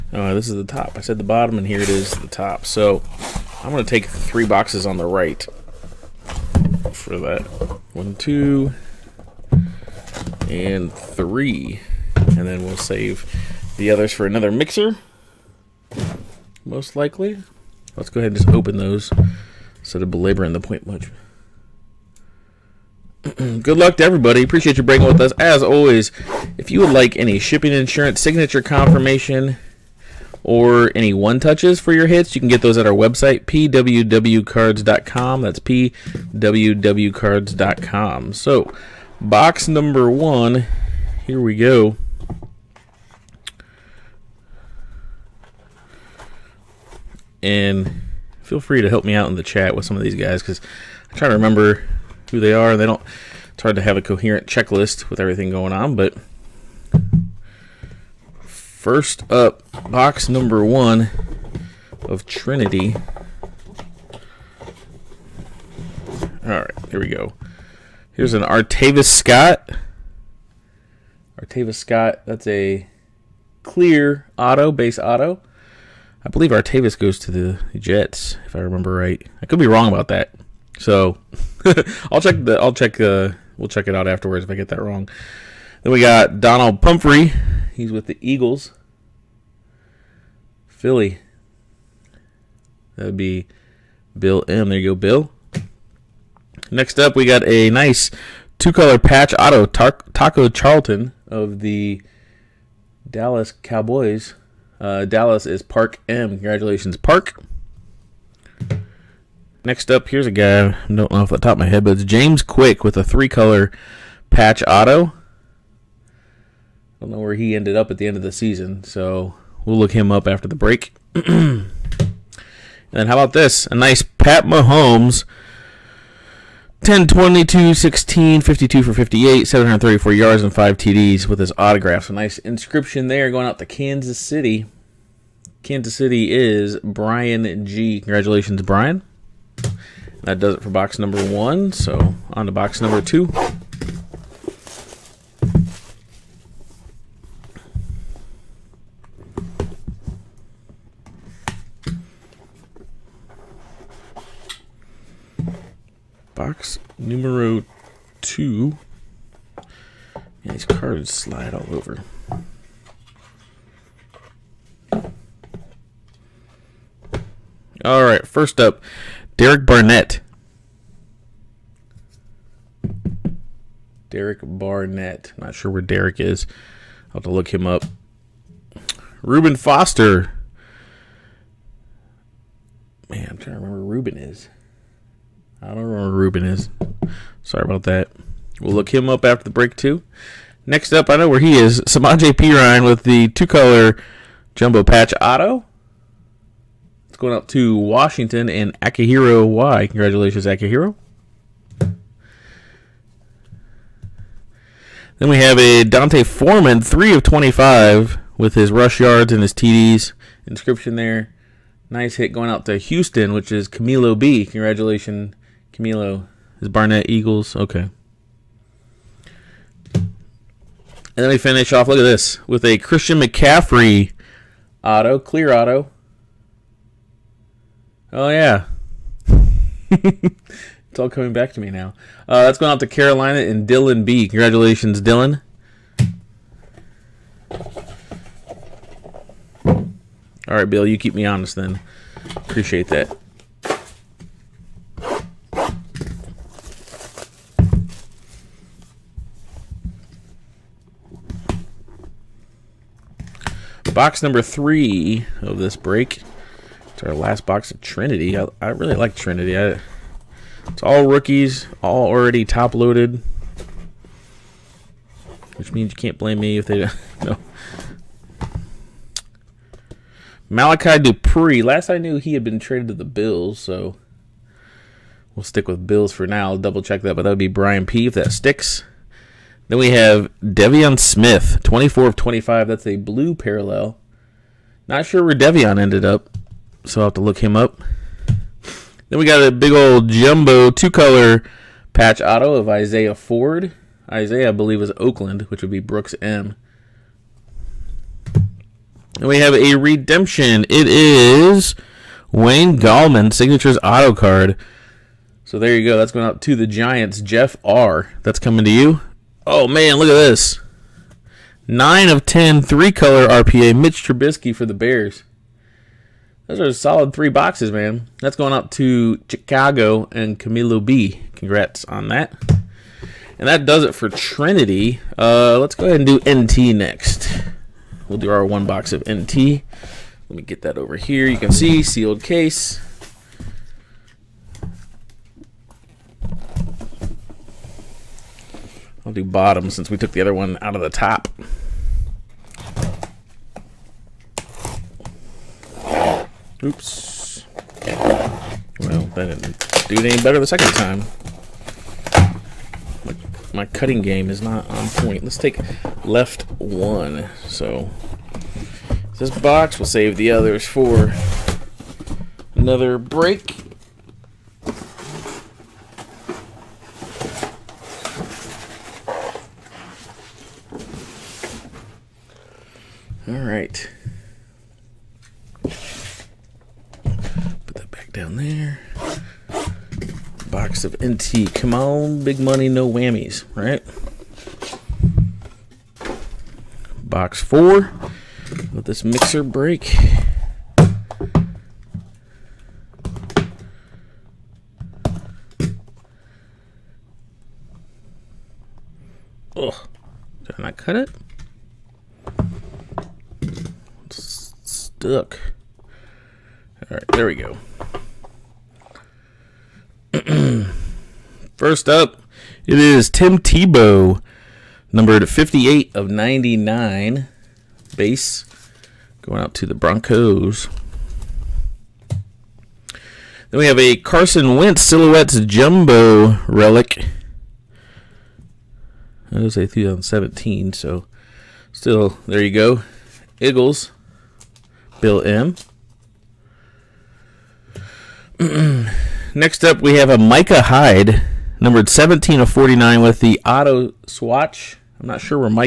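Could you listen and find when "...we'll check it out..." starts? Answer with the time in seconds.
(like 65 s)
83 s.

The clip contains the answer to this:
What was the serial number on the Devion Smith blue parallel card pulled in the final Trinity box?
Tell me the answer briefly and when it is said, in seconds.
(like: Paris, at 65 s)
24 of 25, at 281 s.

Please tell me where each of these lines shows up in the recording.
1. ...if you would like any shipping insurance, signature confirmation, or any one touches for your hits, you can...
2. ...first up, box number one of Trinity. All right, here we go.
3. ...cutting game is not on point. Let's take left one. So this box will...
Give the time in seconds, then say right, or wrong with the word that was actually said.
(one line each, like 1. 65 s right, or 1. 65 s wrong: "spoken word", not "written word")
1. 26 s right
2. 58 s right
3. 353 s right.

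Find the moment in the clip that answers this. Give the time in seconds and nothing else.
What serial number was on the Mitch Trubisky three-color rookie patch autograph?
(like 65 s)
311 s.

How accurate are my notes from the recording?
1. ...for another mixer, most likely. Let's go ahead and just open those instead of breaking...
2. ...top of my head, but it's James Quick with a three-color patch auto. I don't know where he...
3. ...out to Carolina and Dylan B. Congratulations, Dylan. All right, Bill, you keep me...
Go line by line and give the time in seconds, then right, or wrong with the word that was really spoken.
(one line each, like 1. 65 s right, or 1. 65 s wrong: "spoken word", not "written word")
1. 14 s wrong: "belaboring", not "breaking"
2. 111 s right
3. 232 s right.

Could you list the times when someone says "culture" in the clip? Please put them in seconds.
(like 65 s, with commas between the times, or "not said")
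not said.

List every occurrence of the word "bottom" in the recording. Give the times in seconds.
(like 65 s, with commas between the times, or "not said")
1 s, 339 s.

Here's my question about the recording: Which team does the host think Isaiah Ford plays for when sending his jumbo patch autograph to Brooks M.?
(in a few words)
Oakland.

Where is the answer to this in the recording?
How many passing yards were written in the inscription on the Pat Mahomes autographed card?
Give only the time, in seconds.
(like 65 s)
129 s.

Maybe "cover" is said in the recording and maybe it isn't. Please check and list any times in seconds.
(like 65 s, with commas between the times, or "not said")
not said.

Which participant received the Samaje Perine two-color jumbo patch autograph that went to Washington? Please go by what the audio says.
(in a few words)
Akihiro Y.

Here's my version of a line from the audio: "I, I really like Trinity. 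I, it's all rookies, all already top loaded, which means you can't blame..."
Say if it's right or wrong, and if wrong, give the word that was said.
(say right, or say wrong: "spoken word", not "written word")
right.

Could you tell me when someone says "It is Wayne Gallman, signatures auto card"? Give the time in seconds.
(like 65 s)
300 s.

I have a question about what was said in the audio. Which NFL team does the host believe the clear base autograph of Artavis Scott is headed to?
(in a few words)
Jets.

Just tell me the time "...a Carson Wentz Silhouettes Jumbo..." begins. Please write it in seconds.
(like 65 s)
423 s.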